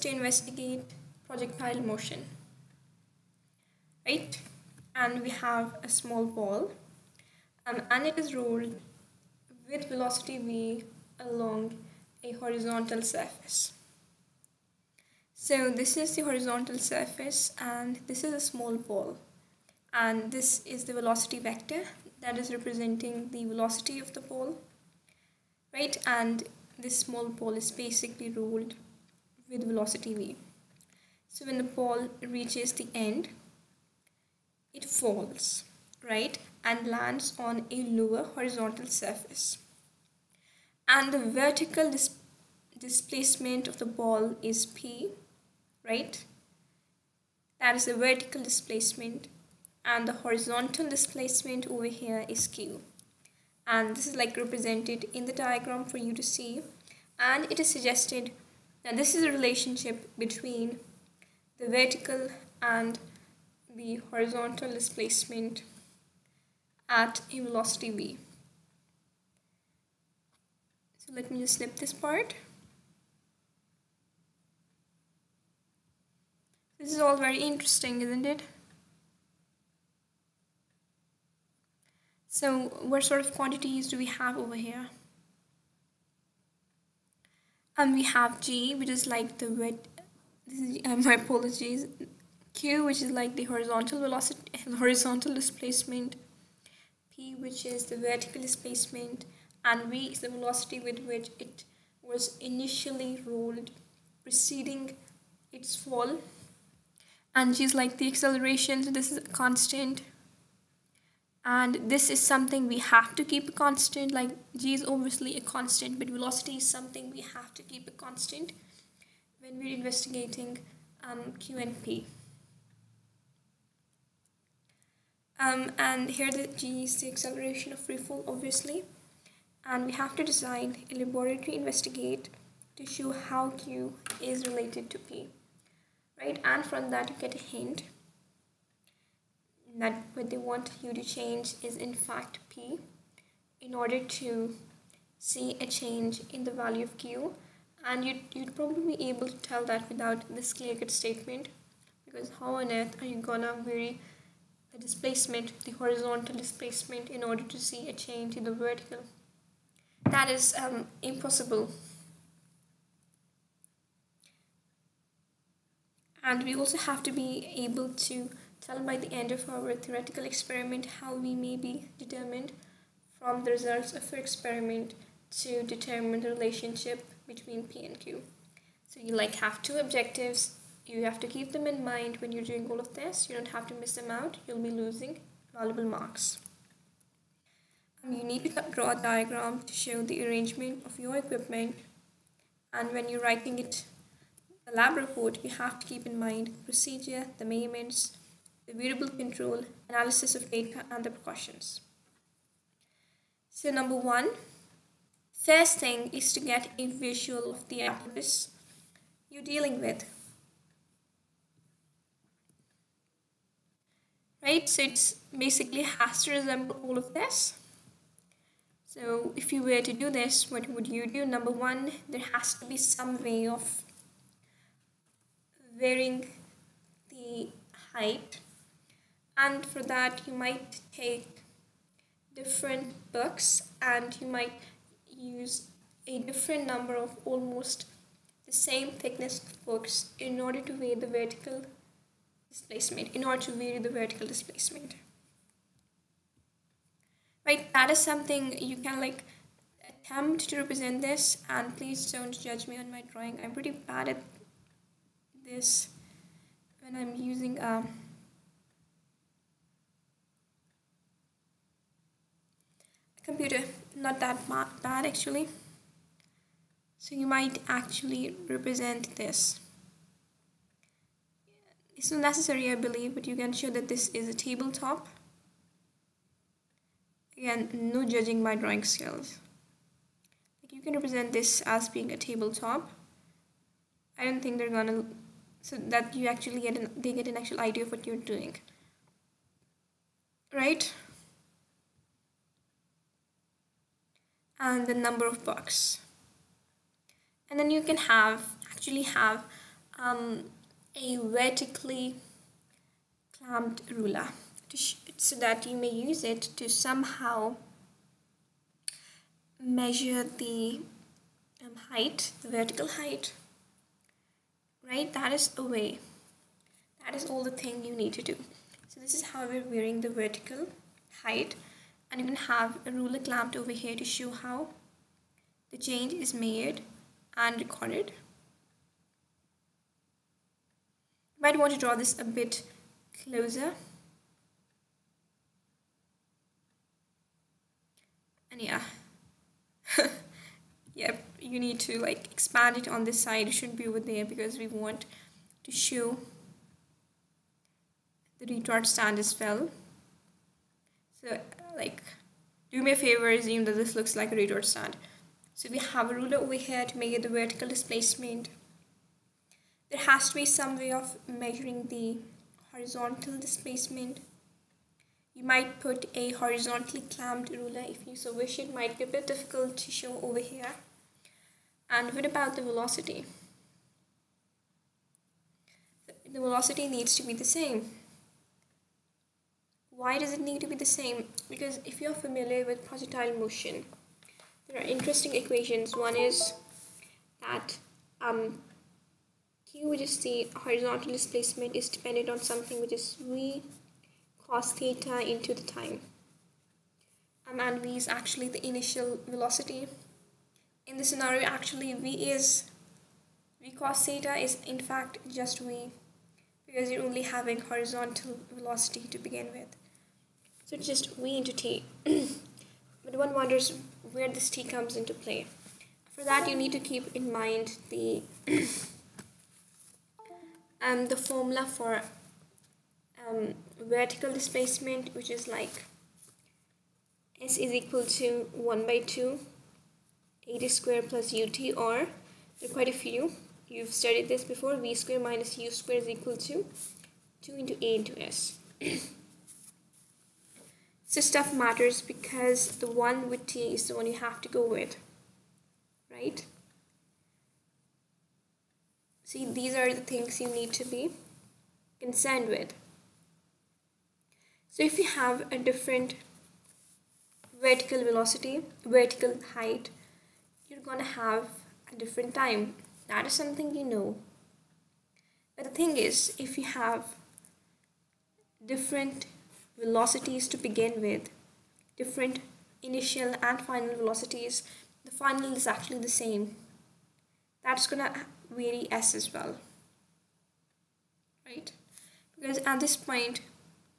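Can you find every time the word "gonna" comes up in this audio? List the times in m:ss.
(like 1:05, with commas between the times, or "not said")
2:33, 4:44, 7:40, 7:57.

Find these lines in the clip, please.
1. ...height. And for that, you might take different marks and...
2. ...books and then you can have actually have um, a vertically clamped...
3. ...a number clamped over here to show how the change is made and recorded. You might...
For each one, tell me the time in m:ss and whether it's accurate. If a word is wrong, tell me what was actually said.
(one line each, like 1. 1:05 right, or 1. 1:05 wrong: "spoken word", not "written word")
1. 3:47 wrong: "books", not "marks"
2. 4:55 right
3. 5:22 wrong: "ruler", not "number".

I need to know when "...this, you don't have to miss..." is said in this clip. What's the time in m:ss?
3:02.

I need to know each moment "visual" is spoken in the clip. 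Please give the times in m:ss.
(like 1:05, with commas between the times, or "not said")
3:27.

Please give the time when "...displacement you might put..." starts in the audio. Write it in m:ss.
6:03.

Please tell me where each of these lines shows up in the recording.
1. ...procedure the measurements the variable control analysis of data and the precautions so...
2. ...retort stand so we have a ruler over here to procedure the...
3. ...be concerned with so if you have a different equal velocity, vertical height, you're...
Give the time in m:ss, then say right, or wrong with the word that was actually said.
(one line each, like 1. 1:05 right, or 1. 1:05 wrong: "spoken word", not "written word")
1. 3:16 right
2. 5:54 wrong: "measure", not "procedure"
3. 7:30 wrong: "vertical", not "equal".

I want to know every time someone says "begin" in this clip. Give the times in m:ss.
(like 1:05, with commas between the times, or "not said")
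6:49, 7:50.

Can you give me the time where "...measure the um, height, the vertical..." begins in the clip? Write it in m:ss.
5:09.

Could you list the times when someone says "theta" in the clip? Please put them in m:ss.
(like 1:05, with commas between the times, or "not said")
6:34, 6:44.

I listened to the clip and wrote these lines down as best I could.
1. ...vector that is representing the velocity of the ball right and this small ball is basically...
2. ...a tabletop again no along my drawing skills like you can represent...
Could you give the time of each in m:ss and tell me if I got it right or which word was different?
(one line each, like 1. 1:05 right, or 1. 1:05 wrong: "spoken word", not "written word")
1. 0:21 right
2. 4:34 wrong: "judging", not "along".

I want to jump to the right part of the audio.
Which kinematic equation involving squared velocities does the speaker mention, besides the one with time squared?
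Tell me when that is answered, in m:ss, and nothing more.
7:14.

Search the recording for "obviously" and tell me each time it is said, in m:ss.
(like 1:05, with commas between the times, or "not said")
1:54, 2:08.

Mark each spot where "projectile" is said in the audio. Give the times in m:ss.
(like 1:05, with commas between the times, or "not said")
0:01, 6:22.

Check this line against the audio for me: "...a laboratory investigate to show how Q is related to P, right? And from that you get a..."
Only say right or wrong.
right.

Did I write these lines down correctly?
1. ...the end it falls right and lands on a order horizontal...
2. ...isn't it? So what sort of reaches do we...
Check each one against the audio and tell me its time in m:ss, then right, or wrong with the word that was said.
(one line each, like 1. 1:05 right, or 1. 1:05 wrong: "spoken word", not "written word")
1. 0:32 wrong: "lower", not "order"
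2. 1:18 wrong: "quantities", not "reaches".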